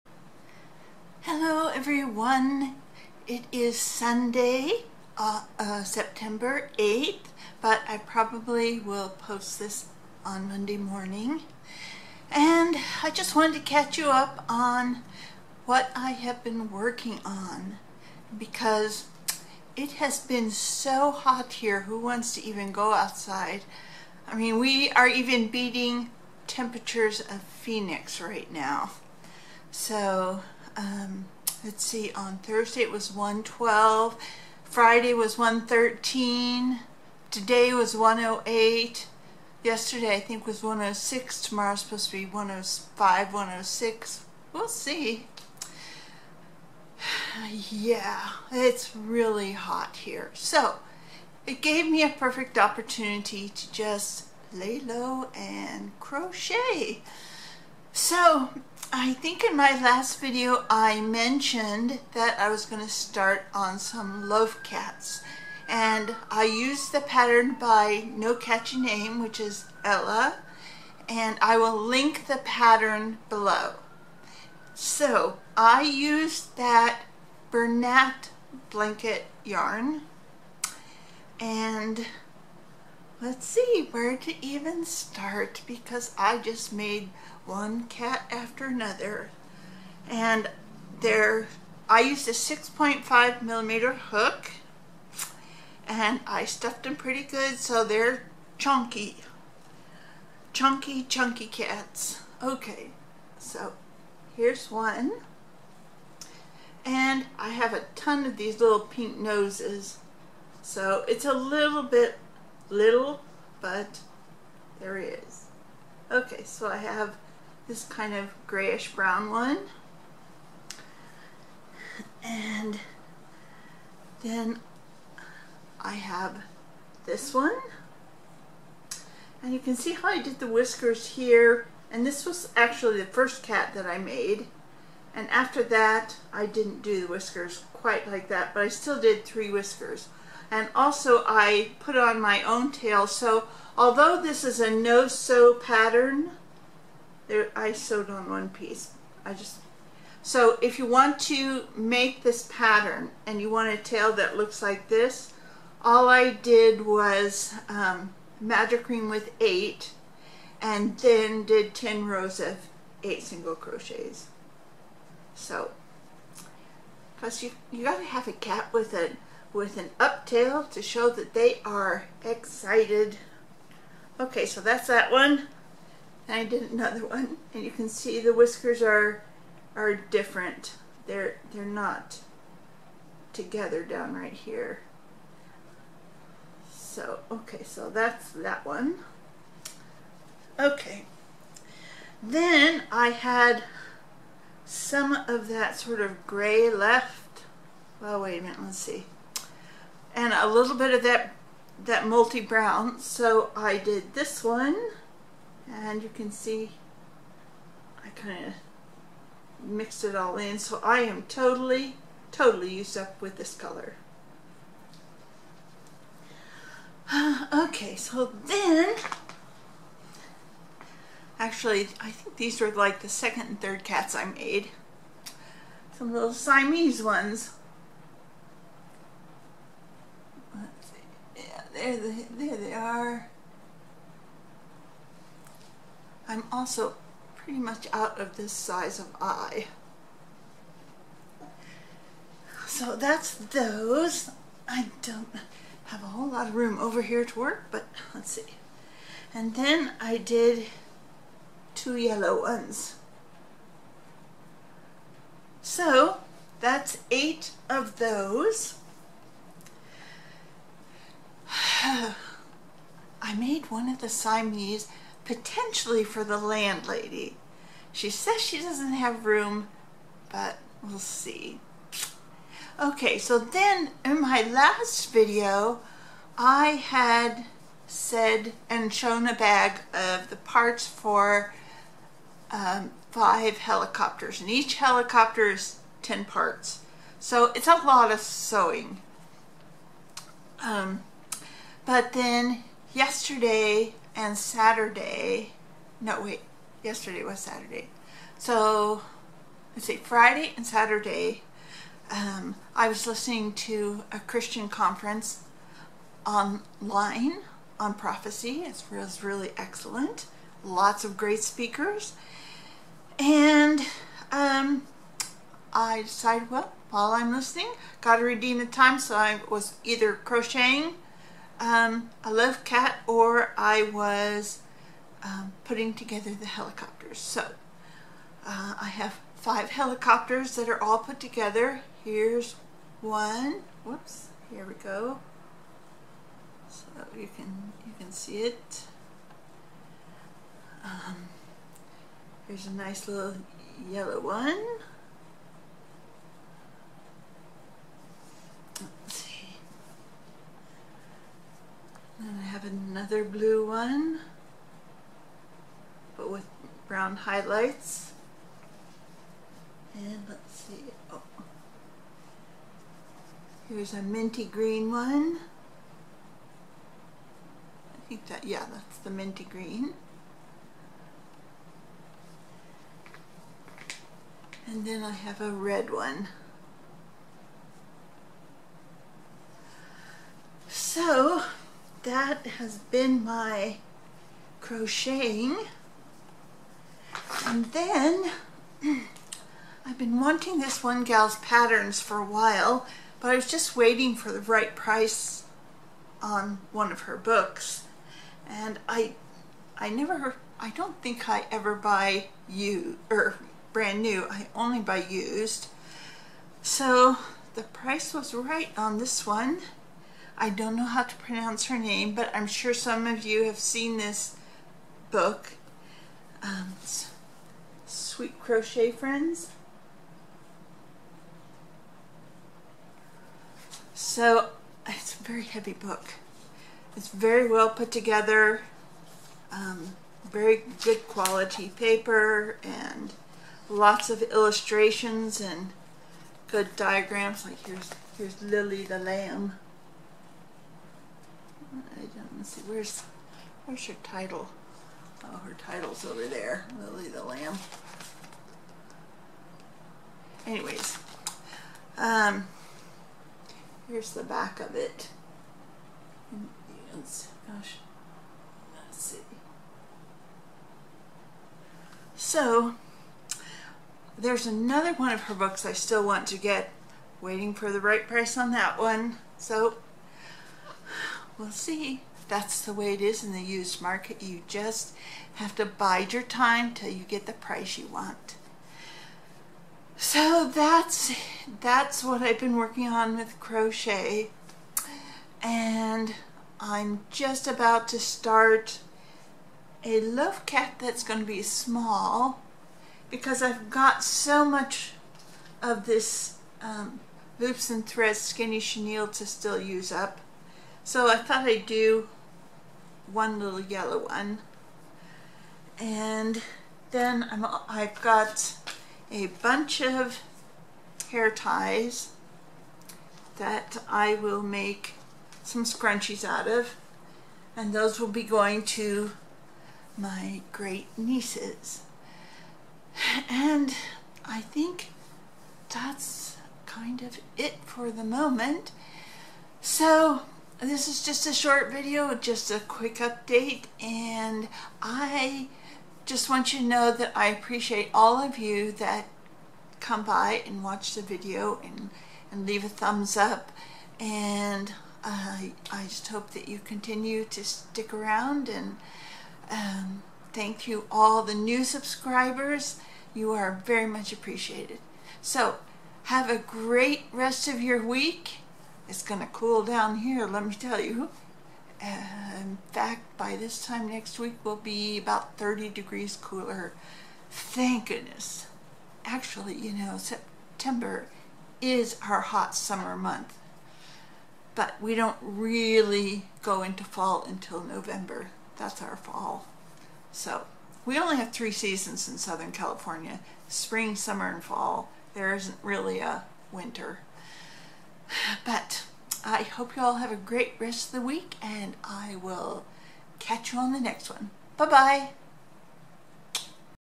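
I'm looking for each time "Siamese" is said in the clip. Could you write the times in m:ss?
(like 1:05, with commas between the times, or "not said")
3:46, 4:24.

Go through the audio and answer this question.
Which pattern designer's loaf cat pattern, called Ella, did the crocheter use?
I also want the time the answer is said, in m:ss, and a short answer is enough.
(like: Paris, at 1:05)
No Catchy Name, at 1:08.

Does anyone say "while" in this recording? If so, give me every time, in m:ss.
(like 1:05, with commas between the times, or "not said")
5:16, 6:32.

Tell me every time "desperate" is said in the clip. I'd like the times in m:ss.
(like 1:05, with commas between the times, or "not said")
not said.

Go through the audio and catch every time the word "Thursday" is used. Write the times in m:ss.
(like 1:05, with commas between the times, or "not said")
0:32.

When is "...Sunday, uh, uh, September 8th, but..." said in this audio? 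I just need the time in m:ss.
0:03.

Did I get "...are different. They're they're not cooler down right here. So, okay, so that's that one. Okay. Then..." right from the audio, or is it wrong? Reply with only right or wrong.
wrong.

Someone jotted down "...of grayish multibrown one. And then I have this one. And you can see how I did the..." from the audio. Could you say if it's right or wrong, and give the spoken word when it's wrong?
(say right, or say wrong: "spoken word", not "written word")
wrong: "brown", not "multibrown".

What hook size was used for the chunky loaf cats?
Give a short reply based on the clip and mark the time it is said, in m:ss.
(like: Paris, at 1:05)
6.5 millimeter, at 1:32.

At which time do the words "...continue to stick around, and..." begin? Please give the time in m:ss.
9:06.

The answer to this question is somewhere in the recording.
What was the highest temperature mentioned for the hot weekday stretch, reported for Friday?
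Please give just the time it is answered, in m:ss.
0:34.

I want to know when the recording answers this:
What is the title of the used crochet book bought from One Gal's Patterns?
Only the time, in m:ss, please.
6:57.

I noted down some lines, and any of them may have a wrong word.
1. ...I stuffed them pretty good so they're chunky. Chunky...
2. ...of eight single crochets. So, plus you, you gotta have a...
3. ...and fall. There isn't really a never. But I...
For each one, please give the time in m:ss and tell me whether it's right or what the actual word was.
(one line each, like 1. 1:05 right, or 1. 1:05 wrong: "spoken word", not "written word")
1. 1:36 right
2. 2:42 right
3. 9:44 wrong: "winter", not "never".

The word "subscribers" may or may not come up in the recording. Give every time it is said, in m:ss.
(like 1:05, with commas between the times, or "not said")
9:11.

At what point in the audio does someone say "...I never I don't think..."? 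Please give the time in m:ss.
6:39.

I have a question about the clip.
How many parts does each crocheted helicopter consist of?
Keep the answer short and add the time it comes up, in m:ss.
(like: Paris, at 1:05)
10, at 4:46.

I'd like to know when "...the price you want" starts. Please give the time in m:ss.
7:57.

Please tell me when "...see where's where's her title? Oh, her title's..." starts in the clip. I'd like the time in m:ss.
7:22.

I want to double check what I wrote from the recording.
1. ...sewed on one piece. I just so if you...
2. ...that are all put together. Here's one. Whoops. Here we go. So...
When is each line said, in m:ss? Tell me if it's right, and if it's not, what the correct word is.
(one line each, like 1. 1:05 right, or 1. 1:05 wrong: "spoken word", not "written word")
1. 2:27 right
2. 5:30 right.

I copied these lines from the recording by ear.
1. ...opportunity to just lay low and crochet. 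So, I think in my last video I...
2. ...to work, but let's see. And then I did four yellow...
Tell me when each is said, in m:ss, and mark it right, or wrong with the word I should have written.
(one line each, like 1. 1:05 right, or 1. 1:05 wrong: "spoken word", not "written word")
1. 0:52 right
2. 4:07 wrong: "two", not "four".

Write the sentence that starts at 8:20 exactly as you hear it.
So I thought I'd do one little yellow one.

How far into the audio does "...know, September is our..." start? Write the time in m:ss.
9:29.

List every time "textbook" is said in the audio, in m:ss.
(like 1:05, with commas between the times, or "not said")
not said.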